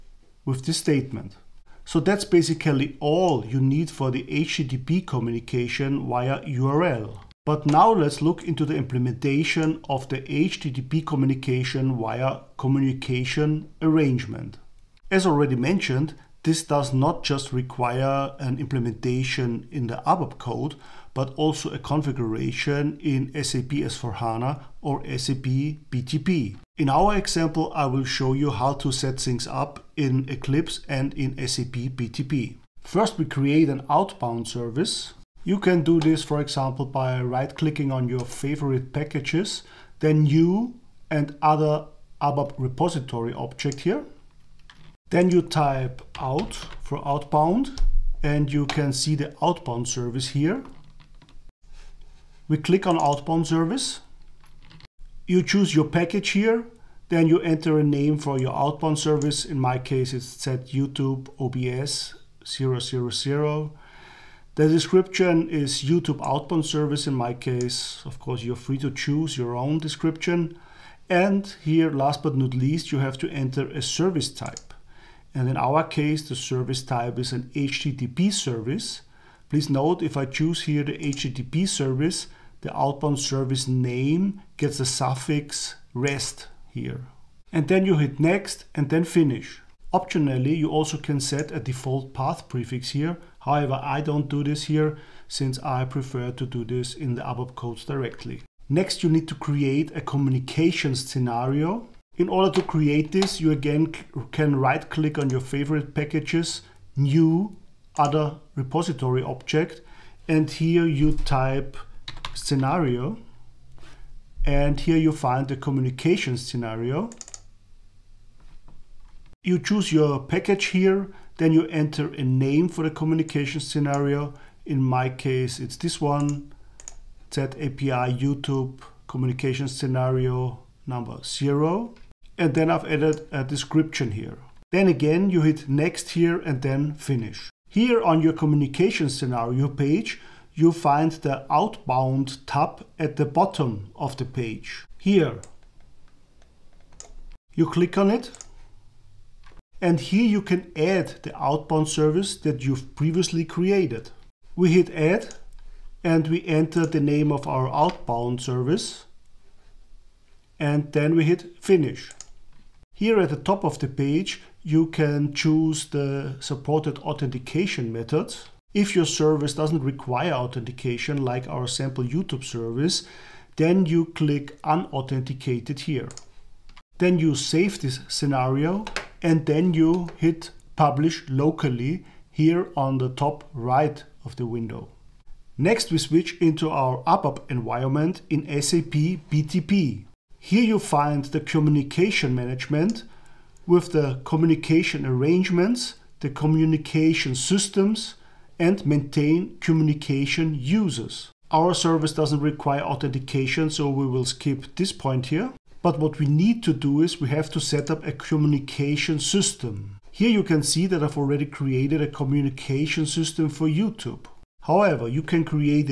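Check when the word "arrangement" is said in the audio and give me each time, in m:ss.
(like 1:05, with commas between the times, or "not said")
0:13, 3:15.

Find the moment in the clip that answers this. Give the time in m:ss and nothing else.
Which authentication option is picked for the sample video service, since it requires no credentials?
2:54.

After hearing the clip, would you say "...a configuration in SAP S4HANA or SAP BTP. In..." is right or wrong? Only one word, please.
right.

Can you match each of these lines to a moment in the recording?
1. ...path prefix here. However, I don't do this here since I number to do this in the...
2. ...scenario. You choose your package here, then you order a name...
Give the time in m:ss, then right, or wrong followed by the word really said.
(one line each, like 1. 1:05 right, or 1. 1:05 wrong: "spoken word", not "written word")
1. 1:32 wrong: "prefer", not "number"
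2. 1:56 wrong: "enter", not "order".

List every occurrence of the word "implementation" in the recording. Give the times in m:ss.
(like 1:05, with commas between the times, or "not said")
0:08, 0:18.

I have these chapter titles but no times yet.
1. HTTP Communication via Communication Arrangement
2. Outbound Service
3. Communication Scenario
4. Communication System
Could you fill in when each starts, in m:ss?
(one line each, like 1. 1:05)
1. 0:06
2. 0:32
3. 1:38
4. 3:25.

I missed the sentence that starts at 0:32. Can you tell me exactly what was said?
First, we create an outbound service.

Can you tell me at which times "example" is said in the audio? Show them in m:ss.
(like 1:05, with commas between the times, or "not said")
0:27, 0:36.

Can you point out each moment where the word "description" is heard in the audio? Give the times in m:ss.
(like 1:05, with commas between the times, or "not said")
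1:04, 1:09, 2:13.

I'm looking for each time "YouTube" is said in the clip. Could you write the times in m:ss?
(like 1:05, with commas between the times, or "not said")
1:00, 1:05, 2:08, 2:52, 3:33.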